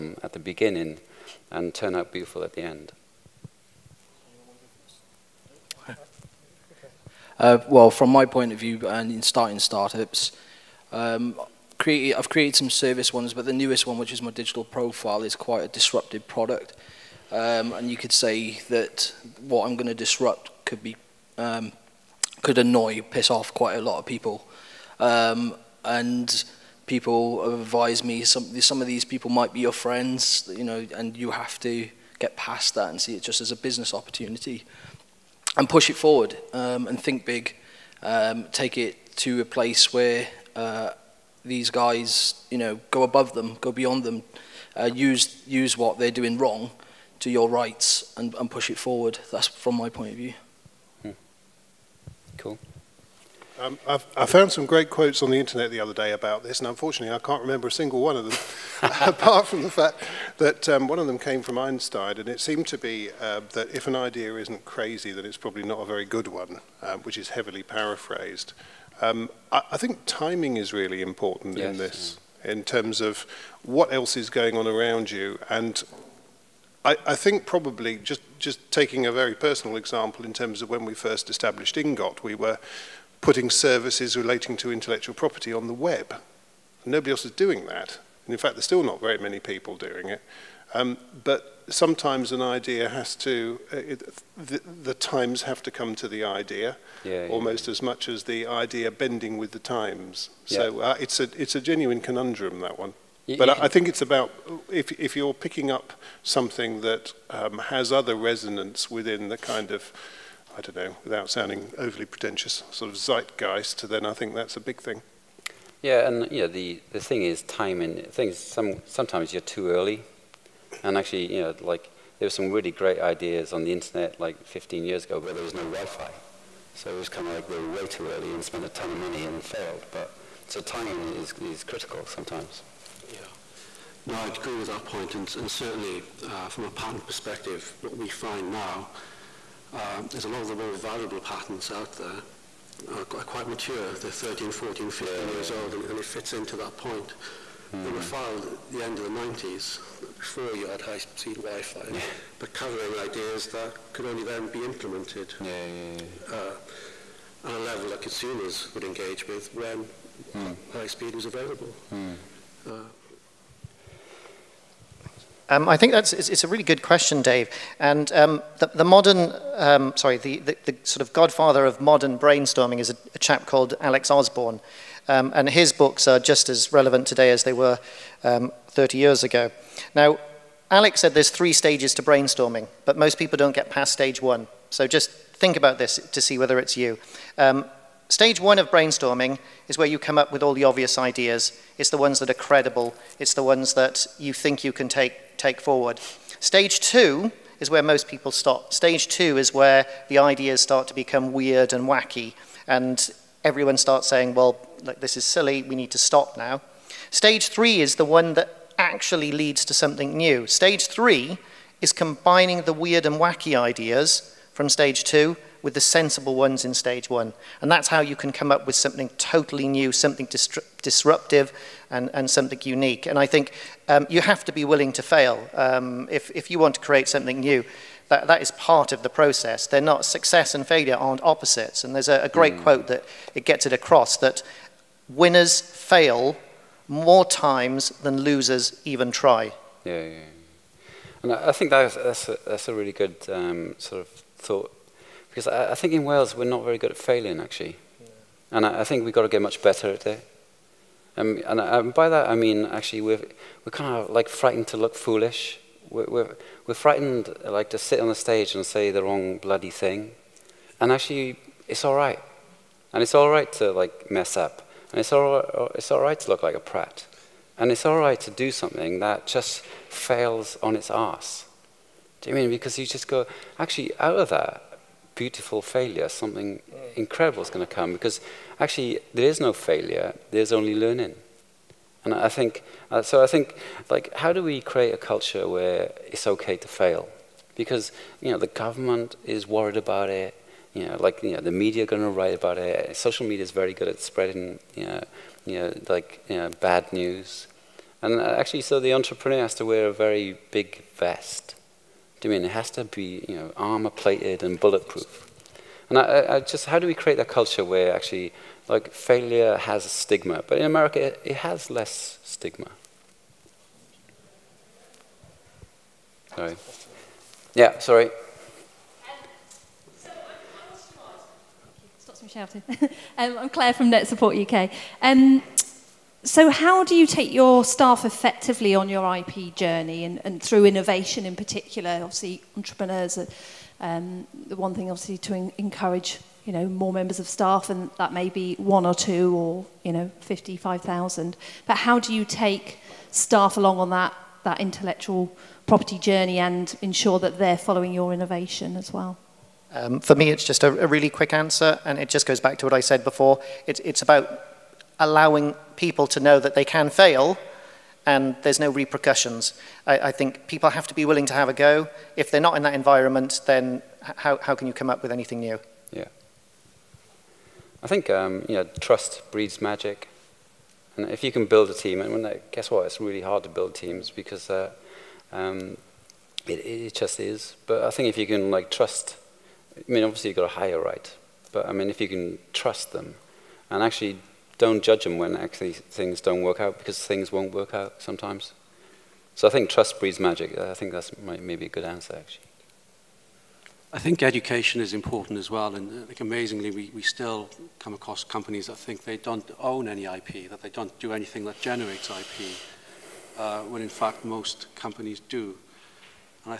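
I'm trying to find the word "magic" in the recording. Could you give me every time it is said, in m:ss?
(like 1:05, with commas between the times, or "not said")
6:09, 6:30.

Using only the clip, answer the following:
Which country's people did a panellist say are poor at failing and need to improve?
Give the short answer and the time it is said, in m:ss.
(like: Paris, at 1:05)
Wales, at 4:06.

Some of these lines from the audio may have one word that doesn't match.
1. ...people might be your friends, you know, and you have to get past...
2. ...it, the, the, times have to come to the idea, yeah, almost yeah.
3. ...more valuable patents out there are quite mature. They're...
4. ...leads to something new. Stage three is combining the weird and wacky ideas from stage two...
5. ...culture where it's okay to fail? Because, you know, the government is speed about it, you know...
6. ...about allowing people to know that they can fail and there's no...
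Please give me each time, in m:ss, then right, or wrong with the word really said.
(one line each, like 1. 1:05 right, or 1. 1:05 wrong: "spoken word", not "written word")
1. 0:29 right
2. 1:33 right
3. 2:20 right
4. 3:29 right
5. 4:44 wrong: "worried", not "speed"
6. 5:54 right.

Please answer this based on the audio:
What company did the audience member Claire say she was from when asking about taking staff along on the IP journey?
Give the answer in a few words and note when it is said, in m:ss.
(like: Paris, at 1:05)
Net Support UK, at 5:23.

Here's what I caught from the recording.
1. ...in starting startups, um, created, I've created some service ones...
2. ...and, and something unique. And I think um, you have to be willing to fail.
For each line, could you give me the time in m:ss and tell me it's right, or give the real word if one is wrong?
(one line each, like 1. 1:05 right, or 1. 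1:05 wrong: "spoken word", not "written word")
1. 0:09 right
2. 3:41 right.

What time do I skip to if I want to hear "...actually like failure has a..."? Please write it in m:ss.
5:07.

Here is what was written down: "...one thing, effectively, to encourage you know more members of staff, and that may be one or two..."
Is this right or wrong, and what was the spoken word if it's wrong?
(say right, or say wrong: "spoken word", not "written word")
wrong: "obviously", not "effectively".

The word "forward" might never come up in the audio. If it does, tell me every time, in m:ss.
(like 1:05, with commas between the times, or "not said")
0:35, 0:48, 3:15.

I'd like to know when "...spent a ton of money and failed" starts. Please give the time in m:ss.
2:08.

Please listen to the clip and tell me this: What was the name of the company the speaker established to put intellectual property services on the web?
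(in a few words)
Ingot.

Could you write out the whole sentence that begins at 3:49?
They're not, success and failure aren't opposites.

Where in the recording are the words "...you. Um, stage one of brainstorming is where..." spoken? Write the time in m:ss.
3:06.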